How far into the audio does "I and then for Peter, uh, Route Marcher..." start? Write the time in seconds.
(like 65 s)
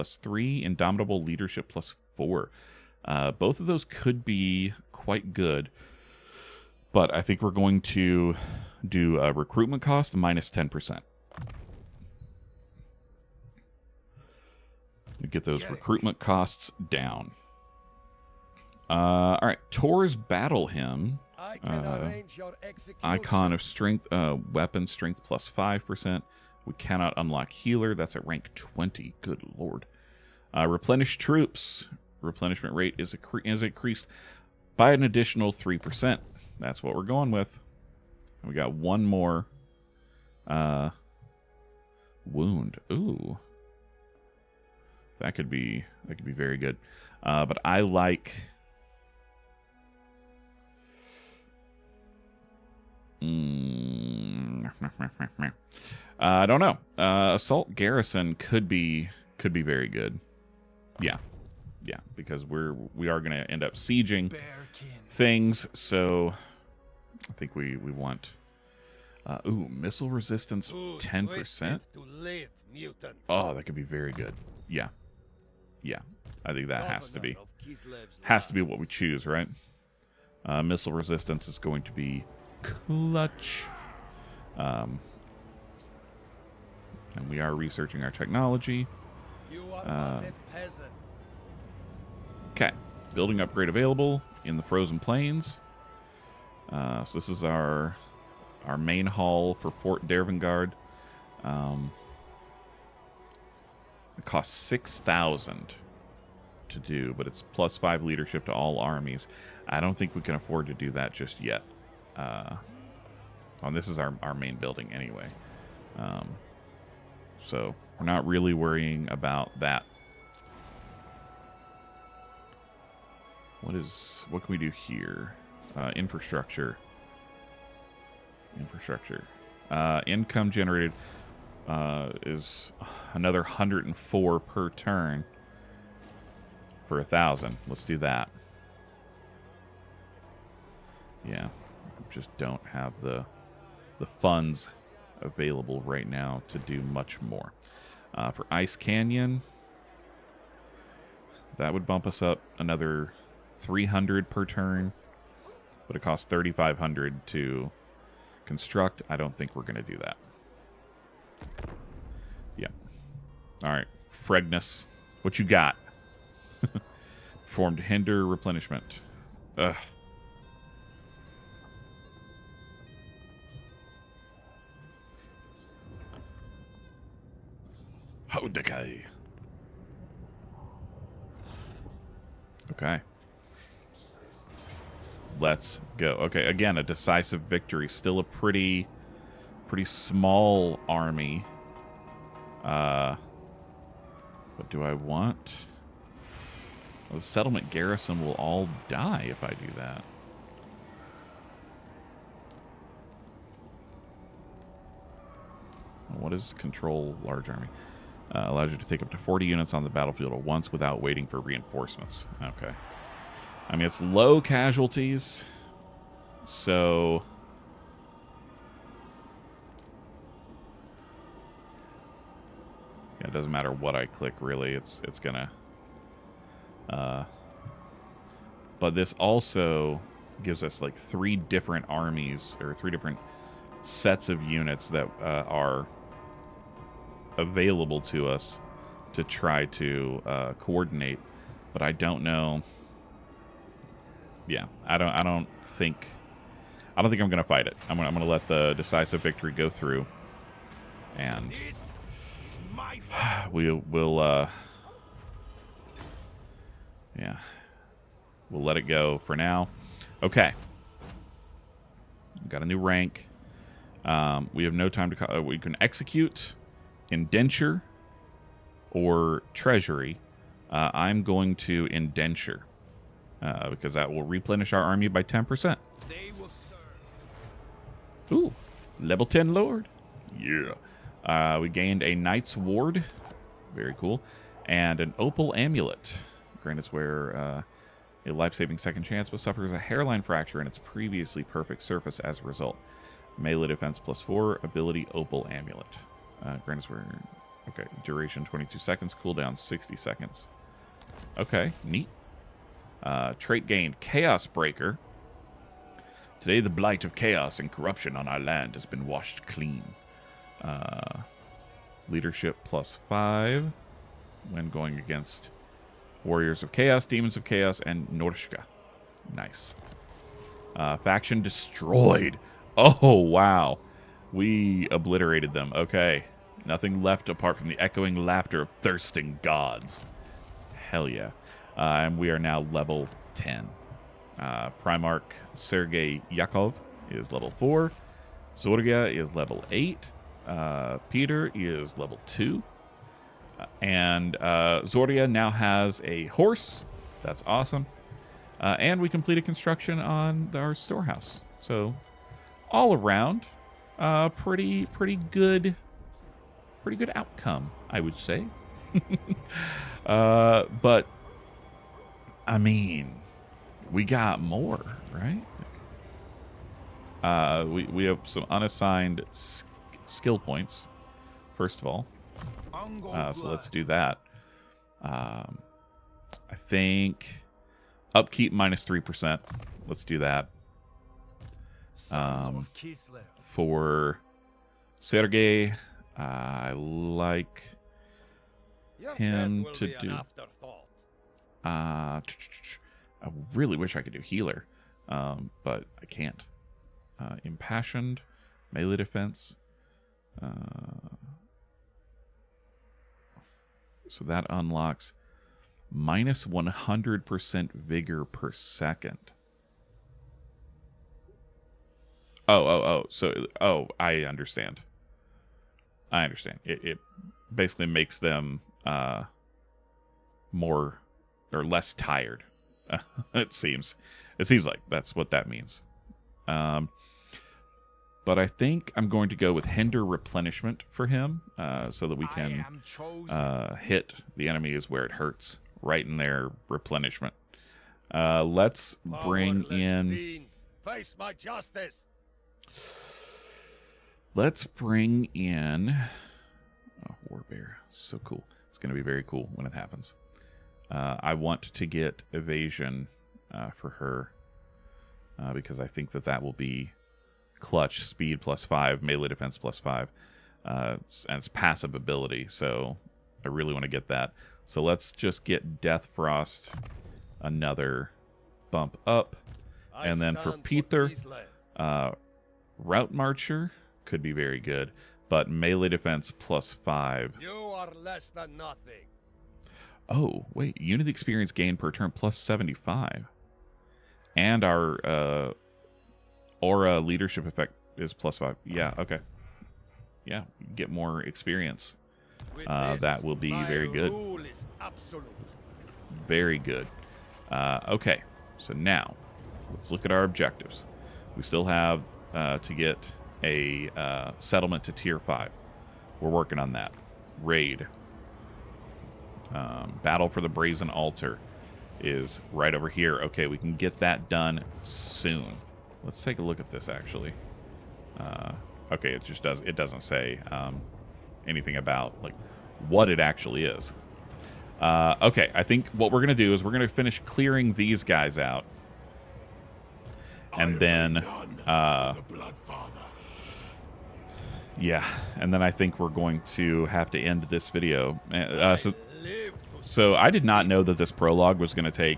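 469 s.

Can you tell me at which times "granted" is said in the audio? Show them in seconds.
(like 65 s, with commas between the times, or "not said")
286 s, 296 s.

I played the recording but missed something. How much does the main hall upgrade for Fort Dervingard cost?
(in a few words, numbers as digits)
6,000.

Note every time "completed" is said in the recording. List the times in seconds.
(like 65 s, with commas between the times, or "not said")
349 s.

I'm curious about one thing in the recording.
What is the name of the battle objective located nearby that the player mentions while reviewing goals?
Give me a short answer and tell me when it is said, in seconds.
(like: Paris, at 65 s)
Battle for the Brazen Altar, at 510 s.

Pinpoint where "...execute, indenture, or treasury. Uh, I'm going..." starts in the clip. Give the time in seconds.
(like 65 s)
265 s.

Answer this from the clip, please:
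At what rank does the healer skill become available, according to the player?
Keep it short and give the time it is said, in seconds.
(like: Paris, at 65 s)
Rank 20, at 28 s.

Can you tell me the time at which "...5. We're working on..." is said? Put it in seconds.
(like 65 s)
505 s.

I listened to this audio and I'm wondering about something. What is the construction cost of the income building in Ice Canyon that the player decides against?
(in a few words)
3,500.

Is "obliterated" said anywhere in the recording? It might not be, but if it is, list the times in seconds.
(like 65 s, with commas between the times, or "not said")
324 s.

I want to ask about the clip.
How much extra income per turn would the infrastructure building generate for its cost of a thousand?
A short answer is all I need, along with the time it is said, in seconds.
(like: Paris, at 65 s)
104, at 133 s.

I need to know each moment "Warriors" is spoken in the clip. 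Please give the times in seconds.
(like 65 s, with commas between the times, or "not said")
316 s.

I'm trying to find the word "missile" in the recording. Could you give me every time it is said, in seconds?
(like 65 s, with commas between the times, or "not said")
69 s, 80 s.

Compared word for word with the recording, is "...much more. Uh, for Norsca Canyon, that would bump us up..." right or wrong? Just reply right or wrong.
wrong.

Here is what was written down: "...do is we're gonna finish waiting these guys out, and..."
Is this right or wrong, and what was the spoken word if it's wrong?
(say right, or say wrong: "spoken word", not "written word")
wrong: "clearing", not "waiting".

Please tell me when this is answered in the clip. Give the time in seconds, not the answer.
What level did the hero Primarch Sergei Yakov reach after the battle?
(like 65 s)
337 s.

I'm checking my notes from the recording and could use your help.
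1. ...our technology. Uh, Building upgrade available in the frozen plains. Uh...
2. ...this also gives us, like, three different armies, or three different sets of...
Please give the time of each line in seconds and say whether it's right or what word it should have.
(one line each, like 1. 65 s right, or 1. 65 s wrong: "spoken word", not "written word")
1. 88 s right
2. 228 s right.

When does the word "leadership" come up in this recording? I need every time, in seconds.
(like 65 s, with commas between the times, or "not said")
1 s, 108 s, 312 s, 486 s.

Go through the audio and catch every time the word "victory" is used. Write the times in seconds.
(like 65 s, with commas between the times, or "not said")
187 s, 249 s.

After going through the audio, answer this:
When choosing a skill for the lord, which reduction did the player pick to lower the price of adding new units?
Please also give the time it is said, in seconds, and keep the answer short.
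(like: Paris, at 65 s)
Recruitment cost minus 10%, at 9 s.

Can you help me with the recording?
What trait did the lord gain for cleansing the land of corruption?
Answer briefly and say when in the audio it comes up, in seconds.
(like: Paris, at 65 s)
Chaos Breaker, at 303 s.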